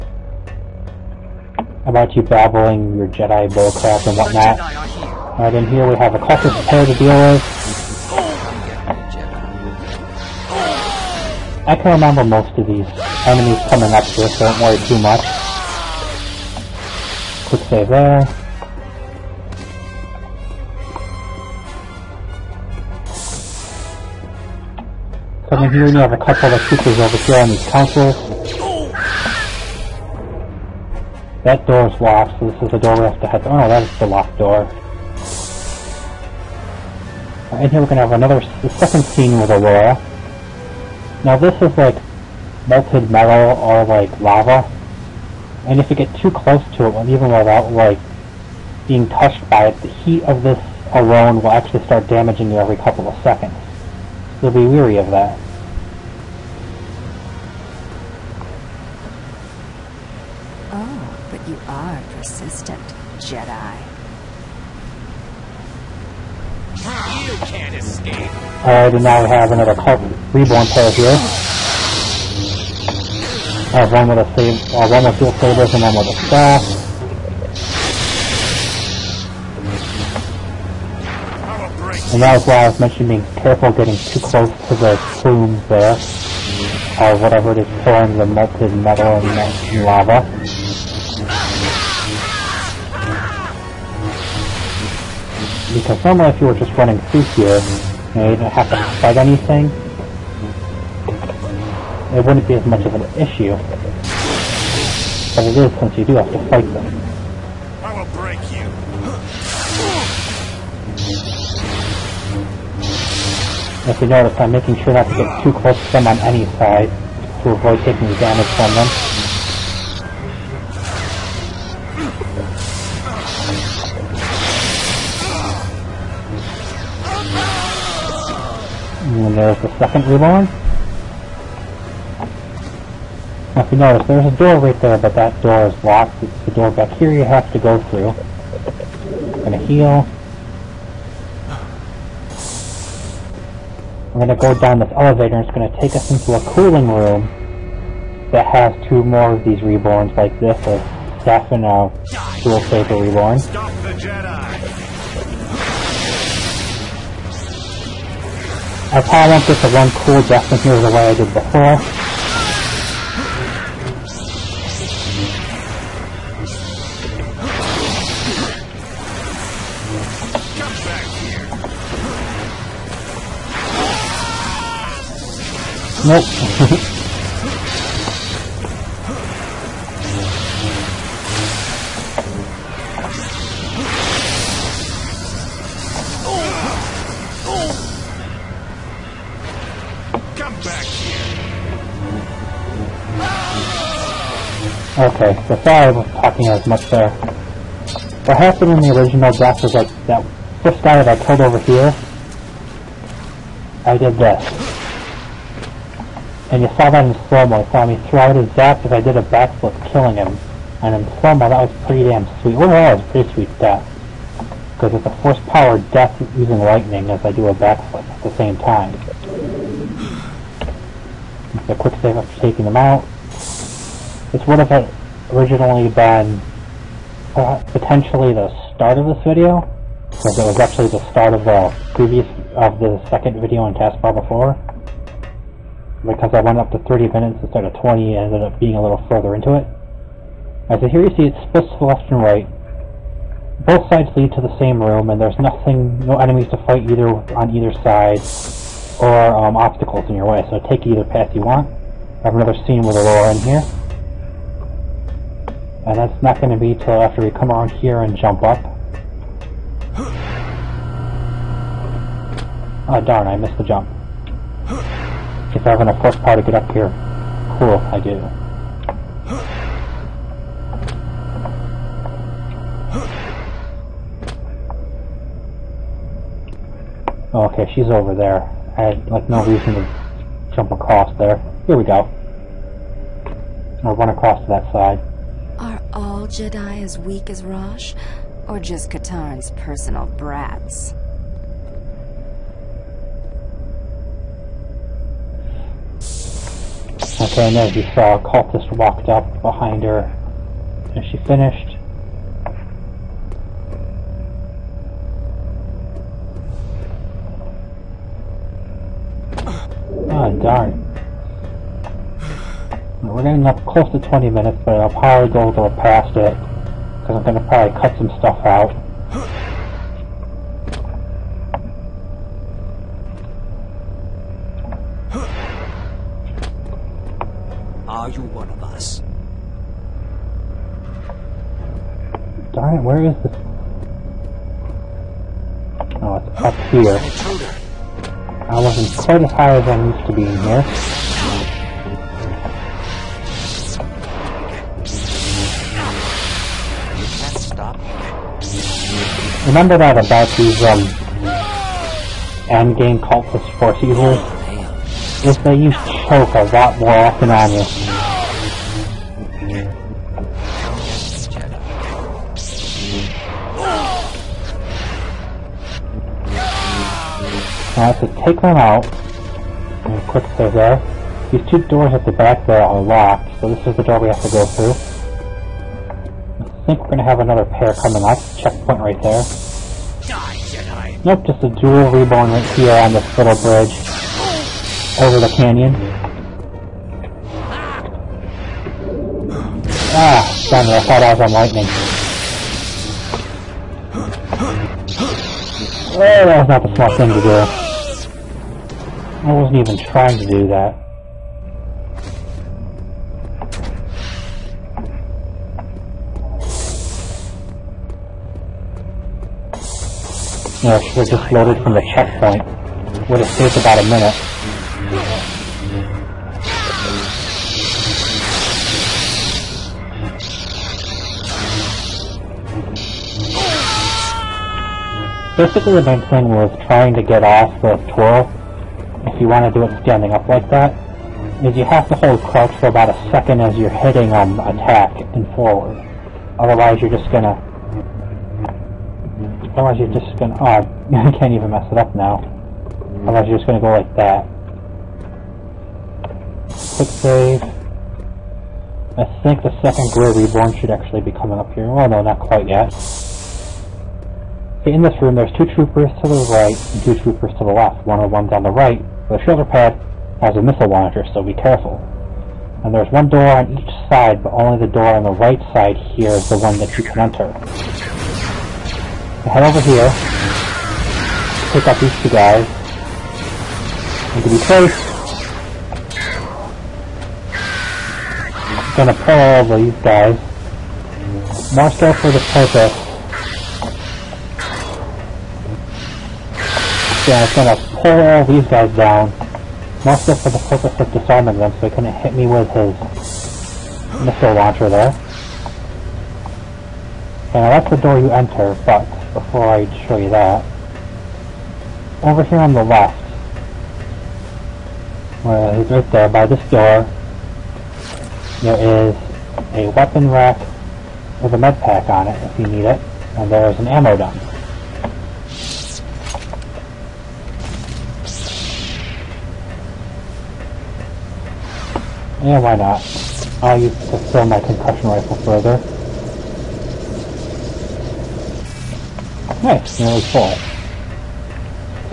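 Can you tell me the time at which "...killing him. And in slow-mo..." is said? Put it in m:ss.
3:29.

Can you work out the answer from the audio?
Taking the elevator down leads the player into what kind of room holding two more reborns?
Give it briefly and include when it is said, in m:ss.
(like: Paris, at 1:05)
cooling room, at 2:26.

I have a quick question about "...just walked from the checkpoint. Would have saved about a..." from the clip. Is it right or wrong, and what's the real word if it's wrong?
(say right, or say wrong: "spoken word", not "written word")
wrong: "loaded", not "walked".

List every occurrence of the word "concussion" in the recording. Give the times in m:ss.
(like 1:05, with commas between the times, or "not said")
8:44.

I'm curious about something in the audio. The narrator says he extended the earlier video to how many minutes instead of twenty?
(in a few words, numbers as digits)
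30.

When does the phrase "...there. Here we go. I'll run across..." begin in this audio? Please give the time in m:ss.
4:41.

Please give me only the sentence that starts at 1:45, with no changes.
But it is since you do have to fight them.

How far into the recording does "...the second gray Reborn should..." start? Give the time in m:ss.
7:29.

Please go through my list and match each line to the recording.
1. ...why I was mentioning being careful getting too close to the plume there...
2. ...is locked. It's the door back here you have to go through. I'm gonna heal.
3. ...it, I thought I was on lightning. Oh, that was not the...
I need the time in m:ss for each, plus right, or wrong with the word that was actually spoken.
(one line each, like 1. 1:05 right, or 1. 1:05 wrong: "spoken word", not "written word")
1. 1:22 right
2. 2:15 right
3. 6:30 right.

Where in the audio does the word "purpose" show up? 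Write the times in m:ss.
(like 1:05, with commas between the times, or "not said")
8:02, 8:10.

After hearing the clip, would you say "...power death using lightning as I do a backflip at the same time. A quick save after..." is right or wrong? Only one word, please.
right.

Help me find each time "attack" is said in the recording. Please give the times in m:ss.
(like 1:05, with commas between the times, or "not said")
7:14.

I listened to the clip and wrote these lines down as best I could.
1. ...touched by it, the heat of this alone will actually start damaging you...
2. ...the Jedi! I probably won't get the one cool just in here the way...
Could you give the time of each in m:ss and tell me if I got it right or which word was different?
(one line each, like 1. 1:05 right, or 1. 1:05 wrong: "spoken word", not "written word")
1. 0:49 right
2. 2:33 right.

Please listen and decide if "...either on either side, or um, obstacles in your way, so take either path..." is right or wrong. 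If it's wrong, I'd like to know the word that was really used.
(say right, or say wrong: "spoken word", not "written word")
right.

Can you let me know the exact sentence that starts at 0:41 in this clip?
Now this is like melted metal or like lava.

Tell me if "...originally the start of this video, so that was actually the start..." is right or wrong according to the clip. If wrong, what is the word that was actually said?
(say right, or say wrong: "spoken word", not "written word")
wrong: "potentially", not "originally".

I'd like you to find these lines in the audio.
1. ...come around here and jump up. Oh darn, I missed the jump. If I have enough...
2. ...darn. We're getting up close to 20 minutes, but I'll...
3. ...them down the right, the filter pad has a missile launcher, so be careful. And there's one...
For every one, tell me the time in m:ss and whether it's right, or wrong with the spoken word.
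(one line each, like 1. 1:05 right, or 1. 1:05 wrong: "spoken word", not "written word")
1. 4:17 right
2. 5:10 right
3. 7:38 right.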